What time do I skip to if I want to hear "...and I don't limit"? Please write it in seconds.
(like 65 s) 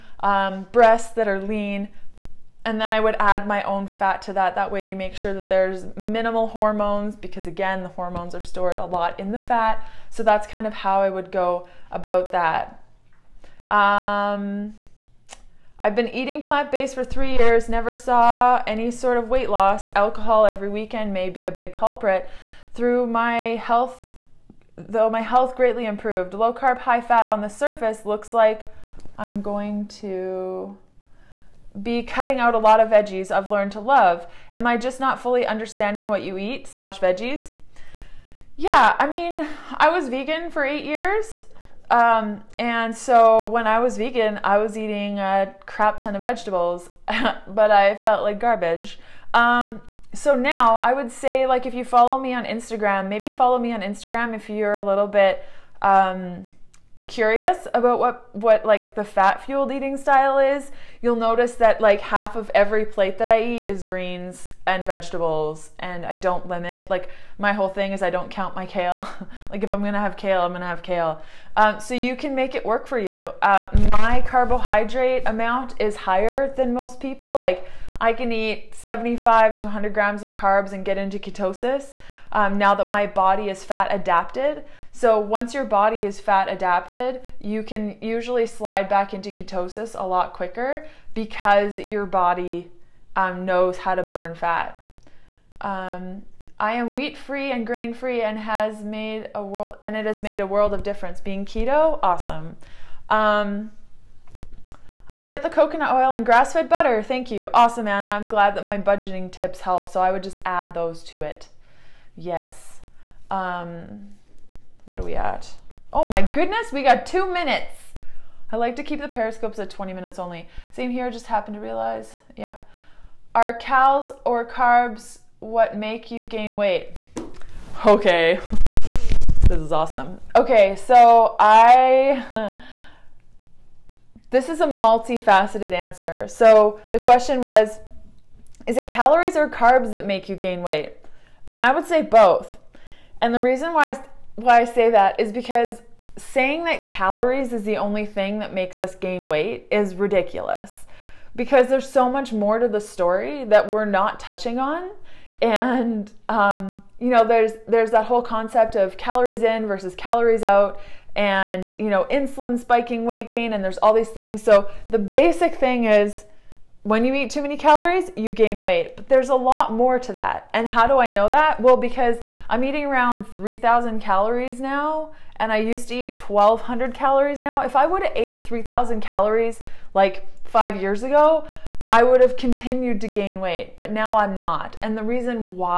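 65 s.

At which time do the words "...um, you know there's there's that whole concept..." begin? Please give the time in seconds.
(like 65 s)
156 s.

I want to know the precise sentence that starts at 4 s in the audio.
That way, you make sure that there's minimal hormones because, again, the hormones are stored a lot in the fat.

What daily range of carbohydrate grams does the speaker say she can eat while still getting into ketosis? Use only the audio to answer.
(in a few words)
75 to 100 grams.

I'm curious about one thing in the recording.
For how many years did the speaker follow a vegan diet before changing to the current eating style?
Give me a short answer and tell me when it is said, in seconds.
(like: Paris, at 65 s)
8 years, at 40 s.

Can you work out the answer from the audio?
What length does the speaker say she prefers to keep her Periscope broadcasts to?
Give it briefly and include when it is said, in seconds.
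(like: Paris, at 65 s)
20 minutes, at 119 s.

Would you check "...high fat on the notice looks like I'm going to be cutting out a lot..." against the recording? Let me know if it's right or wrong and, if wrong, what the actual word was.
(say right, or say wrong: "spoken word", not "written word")
wrong: "surface", not "notice".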